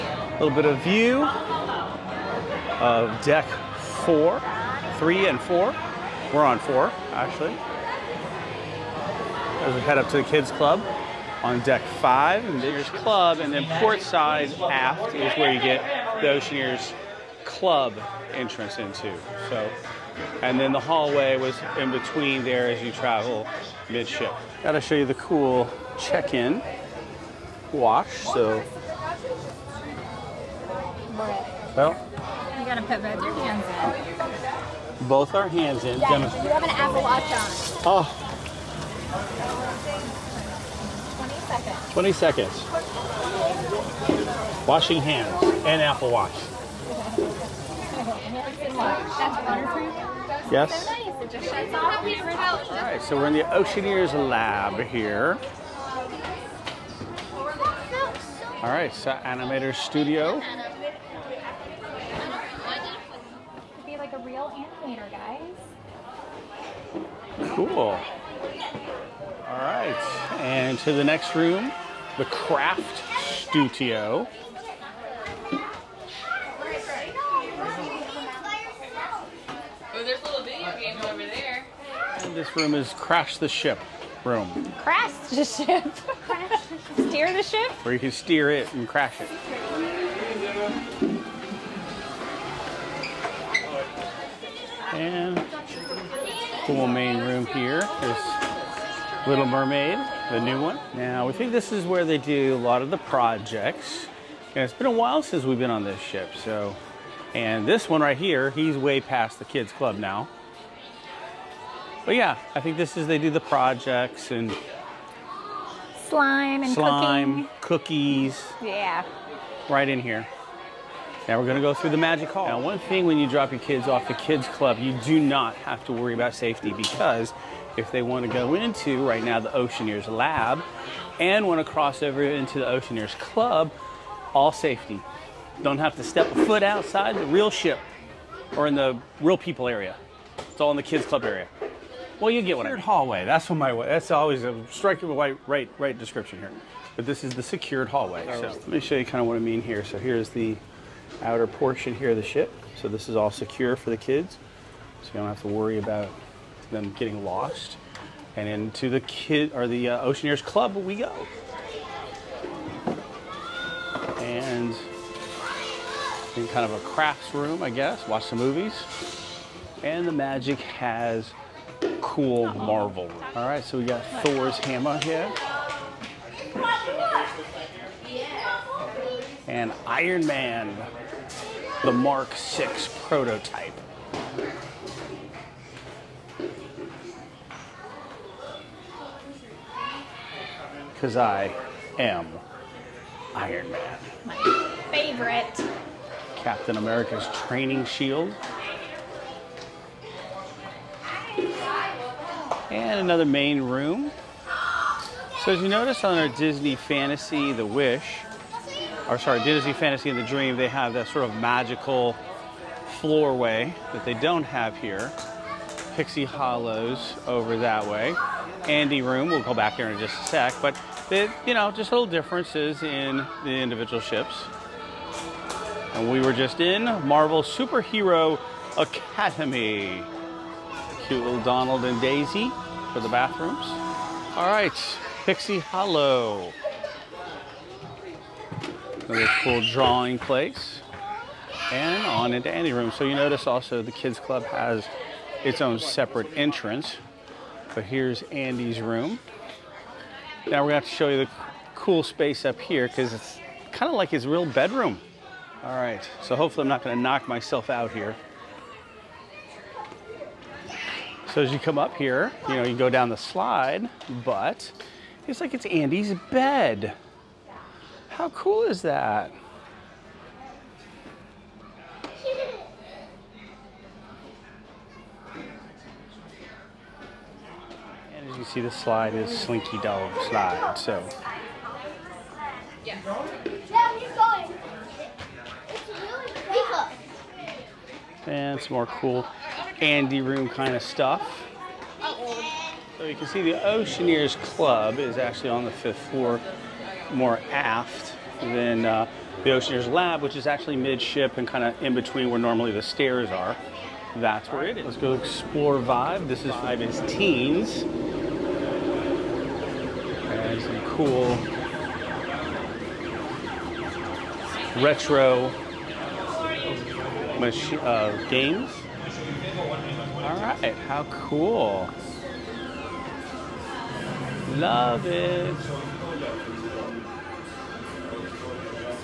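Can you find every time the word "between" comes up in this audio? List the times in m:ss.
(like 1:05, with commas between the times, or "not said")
0:21, 5:01.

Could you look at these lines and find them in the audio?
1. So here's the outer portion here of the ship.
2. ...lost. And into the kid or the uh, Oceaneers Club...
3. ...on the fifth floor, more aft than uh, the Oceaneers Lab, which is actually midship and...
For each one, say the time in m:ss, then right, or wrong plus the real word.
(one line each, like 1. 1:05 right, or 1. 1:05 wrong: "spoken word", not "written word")
1. 2:29 right
2. 2:37 right
3. 4:55 right.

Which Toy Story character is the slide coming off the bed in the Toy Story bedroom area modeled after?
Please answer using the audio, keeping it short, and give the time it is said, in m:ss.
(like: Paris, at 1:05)
Slinky Dog, at 4:39.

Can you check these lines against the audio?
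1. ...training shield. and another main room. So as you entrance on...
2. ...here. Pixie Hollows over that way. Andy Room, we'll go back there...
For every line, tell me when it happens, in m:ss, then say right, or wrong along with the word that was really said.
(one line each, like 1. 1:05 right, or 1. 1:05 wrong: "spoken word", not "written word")
1. 3:17 wrong: "notice", not "entrance"
2. 3:34 right.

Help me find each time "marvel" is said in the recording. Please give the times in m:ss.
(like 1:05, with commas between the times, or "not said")
2:52, 3:47.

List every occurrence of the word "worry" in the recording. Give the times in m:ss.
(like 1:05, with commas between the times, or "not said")
2:05, 2:35.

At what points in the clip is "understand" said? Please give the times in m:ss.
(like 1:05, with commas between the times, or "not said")
not said.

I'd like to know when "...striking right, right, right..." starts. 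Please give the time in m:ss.
2:24.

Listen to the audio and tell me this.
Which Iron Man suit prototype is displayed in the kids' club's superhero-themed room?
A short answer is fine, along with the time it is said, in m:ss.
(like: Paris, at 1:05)
Mark 6, at 3:01.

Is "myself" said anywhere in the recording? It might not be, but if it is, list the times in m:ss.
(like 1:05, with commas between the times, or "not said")
4:17.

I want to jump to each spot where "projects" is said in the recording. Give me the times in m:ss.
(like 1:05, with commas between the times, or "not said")
1:42, 1:53.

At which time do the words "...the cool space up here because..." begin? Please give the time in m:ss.
4:11.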